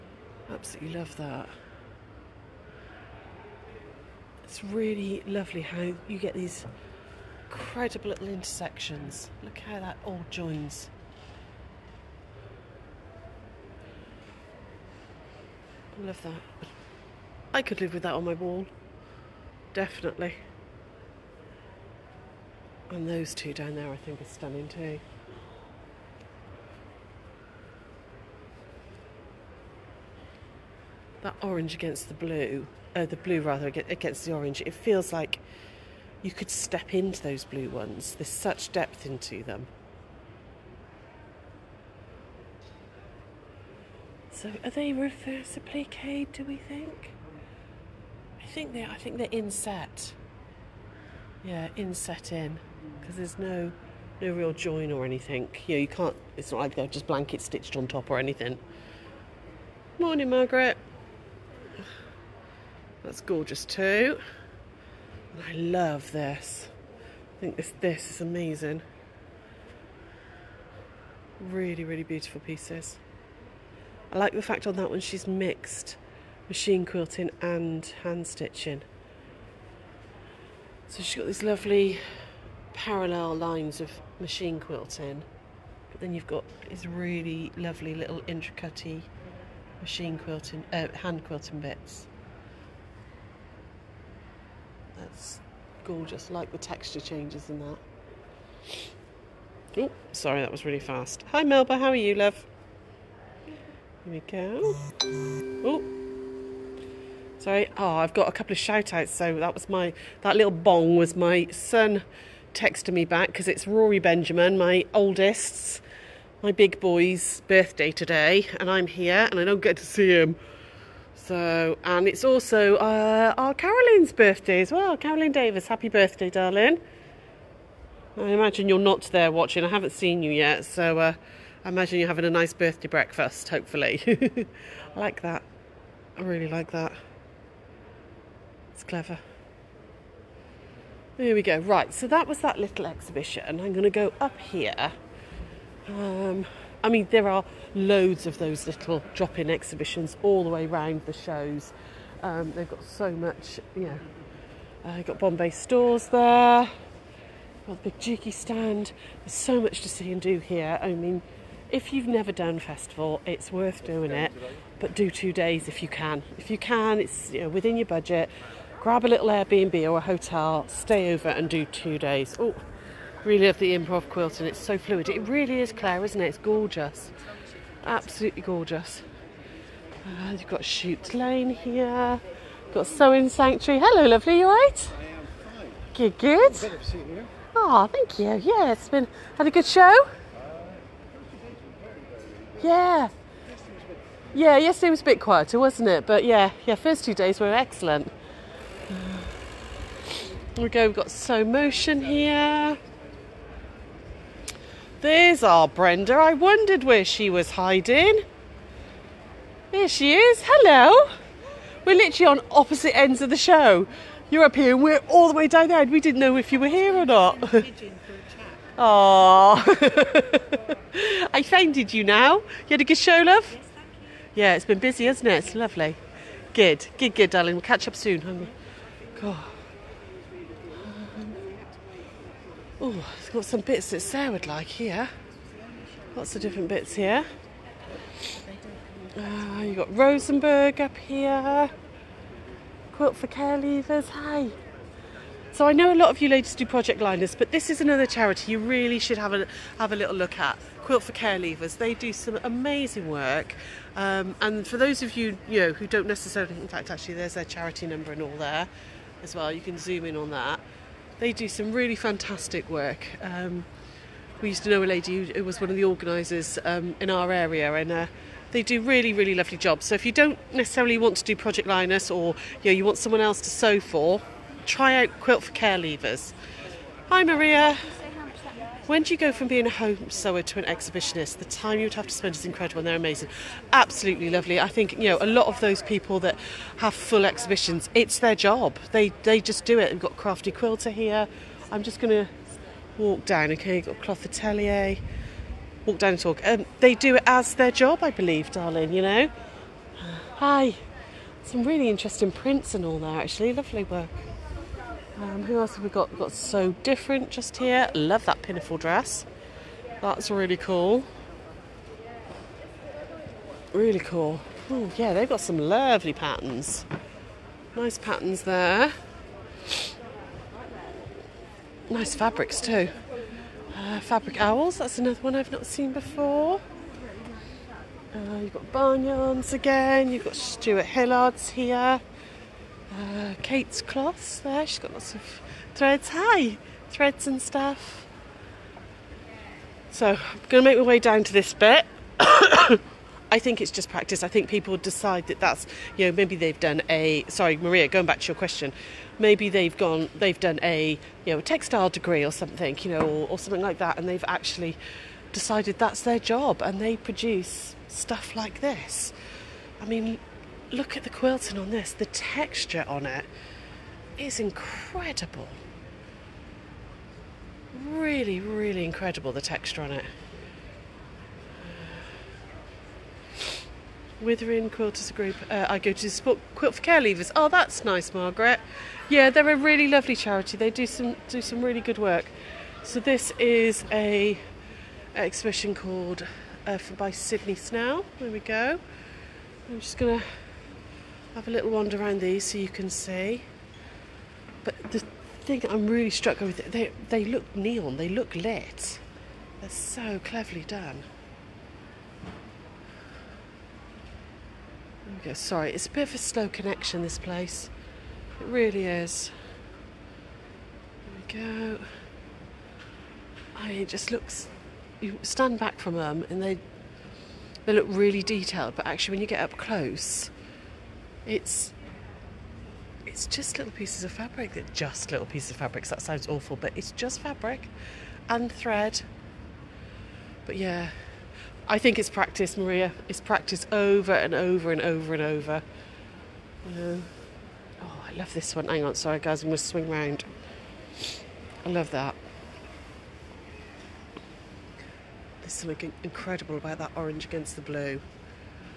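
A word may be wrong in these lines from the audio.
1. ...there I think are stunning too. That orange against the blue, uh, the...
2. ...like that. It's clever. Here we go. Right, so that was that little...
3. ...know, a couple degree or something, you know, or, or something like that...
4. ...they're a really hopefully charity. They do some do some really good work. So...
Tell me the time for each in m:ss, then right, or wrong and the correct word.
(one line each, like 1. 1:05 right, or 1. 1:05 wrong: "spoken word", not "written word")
1. 0:23 right
2. 2:16 right
3. 5:51 wrong: "textile", not "couple"
4. 6:19 wrong: "lovely", not "hopefully".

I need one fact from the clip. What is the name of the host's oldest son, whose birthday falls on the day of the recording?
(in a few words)
Rory Benjamin.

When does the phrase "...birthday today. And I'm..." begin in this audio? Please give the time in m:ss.
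1:57.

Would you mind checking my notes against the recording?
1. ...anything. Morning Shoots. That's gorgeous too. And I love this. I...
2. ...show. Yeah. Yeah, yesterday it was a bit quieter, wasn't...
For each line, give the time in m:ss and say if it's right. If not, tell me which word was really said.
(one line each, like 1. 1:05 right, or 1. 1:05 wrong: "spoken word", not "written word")
1. 0:58 wrong: "Margaret", not "Shoots"
2. 3:09 right.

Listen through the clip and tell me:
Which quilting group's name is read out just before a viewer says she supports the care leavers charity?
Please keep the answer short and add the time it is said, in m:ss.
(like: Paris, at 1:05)
Withering Quilters Group, at 6:14.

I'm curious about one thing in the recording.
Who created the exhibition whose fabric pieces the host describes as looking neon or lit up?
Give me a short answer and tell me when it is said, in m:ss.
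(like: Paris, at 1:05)
Sydney Snell, at 6:27.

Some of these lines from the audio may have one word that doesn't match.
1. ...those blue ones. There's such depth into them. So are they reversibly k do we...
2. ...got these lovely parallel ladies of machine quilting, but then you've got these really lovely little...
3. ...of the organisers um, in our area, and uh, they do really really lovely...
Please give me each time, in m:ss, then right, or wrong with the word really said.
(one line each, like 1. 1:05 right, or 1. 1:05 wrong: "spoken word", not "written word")
1. 0:37 right
2. 1:21 wrong: "lines", not "ladies"
3. 4:25 right.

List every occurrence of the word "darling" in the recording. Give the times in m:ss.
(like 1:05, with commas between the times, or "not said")
2:06, 3:47, 4:58.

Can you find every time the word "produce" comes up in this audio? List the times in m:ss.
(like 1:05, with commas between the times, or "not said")
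5:56.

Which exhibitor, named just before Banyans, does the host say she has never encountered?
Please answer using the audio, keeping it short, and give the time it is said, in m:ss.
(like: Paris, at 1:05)
Fabric Owls, at 5:23.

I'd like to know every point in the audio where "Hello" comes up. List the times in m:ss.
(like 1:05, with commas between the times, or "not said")
3:03, 3:30.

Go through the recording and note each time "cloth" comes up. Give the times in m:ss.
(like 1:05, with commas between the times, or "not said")
4:54, 5:33.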